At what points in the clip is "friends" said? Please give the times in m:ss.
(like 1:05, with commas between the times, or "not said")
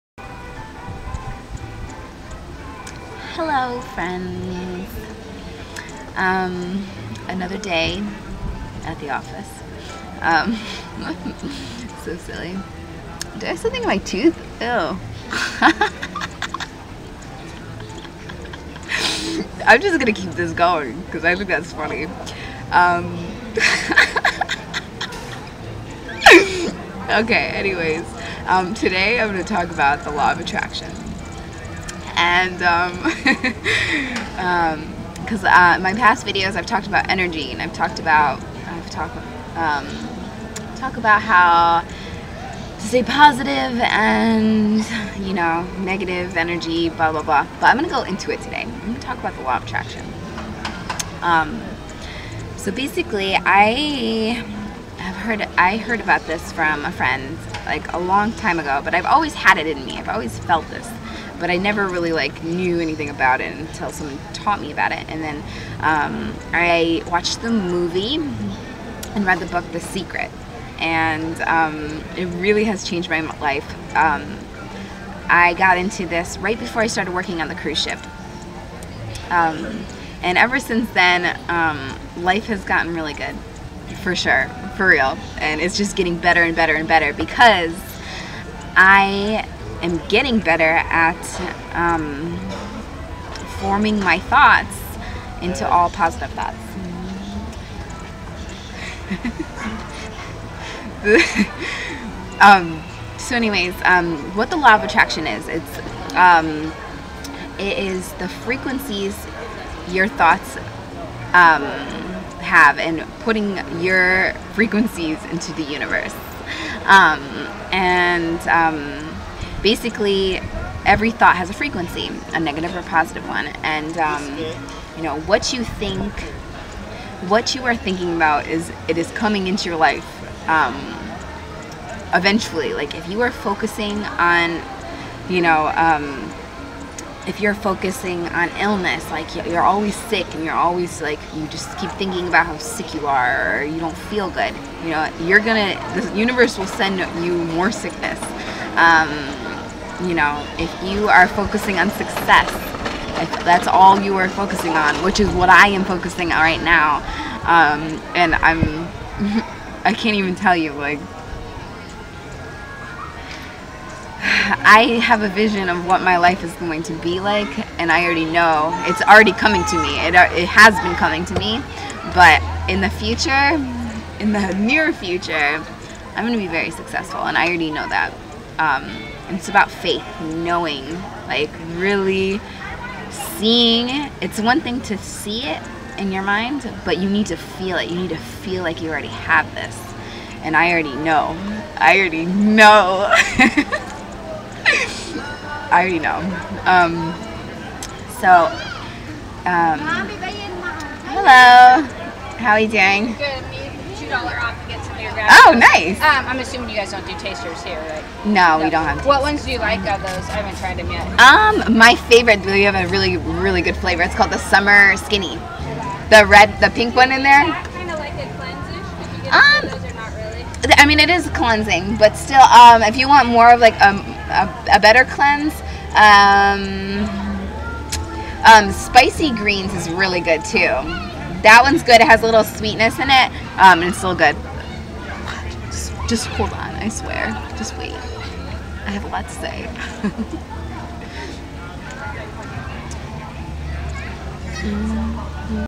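0:03, 0:56.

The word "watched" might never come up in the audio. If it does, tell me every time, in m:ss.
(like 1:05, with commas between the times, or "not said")
1:07.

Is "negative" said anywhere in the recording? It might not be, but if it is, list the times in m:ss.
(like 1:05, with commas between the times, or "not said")
0:45, 2:02.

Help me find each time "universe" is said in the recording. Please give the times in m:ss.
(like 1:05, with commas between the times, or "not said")
1:55, 2:26.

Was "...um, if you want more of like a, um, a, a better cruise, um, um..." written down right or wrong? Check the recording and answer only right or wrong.
wrong.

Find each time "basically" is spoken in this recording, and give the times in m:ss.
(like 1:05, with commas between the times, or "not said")
0:52, 1:59.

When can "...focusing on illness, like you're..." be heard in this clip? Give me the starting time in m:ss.
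2:17.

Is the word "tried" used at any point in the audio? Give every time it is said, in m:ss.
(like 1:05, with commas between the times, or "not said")
3:30.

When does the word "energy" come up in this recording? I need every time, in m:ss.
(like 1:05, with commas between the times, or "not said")
0:37, 0:46.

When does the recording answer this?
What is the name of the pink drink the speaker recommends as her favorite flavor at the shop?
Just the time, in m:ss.
3:34.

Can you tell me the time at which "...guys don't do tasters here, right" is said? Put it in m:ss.
3:26.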